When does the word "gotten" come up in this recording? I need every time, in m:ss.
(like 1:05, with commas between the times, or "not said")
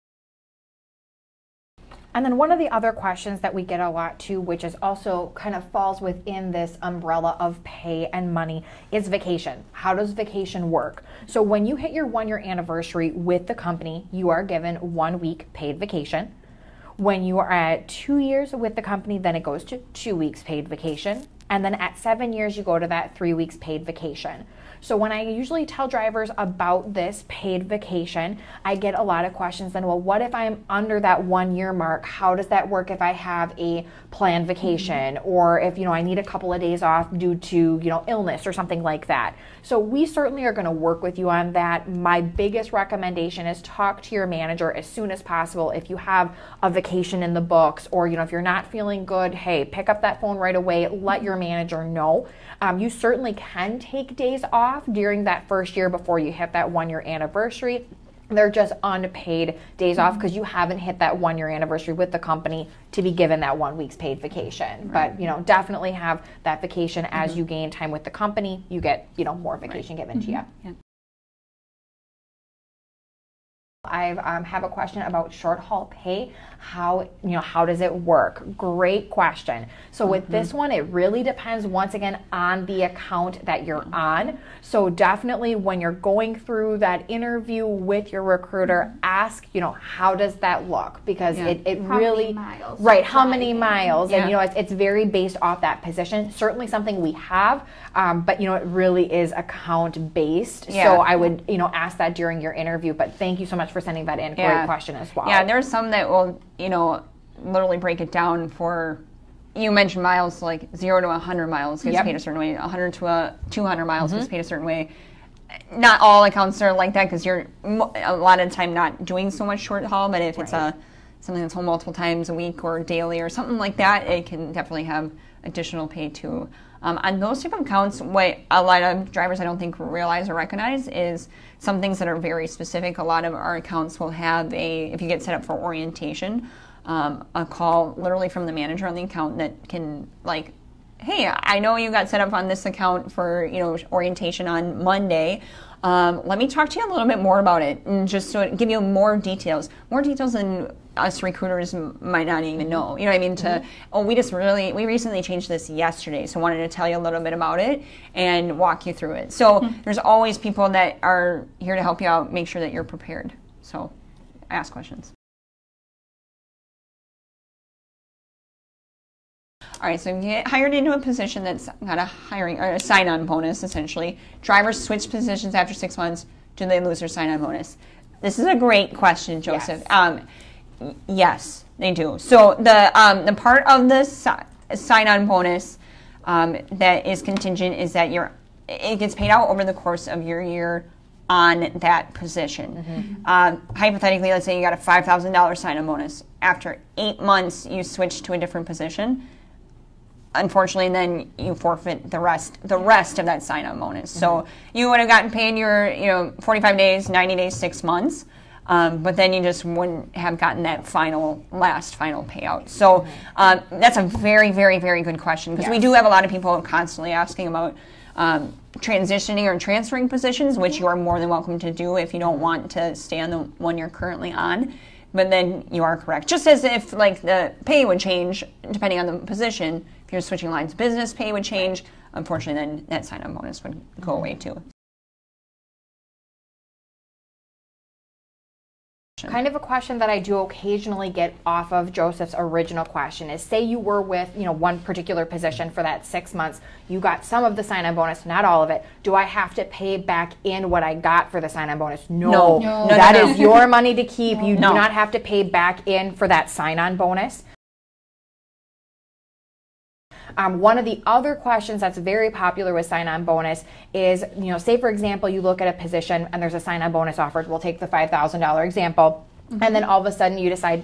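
3:25, 3:30.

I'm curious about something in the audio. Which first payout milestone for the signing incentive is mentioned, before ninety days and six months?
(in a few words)
45 days.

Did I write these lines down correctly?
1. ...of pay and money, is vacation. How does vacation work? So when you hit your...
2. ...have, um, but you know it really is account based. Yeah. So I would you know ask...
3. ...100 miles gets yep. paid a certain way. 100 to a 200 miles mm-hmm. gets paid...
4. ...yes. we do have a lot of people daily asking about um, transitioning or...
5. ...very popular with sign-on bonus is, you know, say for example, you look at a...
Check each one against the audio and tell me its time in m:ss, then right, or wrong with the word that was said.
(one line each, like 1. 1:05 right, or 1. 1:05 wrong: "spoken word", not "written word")
1. 0:07 right
2. 1:37 right
3. 1:51 right
4. 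3:35 wrong: "constantly", not "daily"
5. 4:21 right.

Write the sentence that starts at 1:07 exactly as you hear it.
you gain time with the company you get you know more vacation right.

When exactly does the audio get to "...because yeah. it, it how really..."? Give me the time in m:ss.
1:31.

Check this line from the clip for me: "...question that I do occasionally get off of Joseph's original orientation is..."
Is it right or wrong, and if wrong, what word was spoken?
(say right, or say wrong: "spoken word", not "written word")
wrong: "question", not "orientation".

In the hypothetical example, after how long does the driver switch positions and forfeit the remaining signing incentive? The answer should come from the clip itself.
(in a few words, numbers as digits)
8 months.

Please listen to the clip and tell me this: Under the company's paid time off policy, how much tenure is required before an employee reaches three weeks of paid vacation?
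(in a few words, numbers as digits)
7 years.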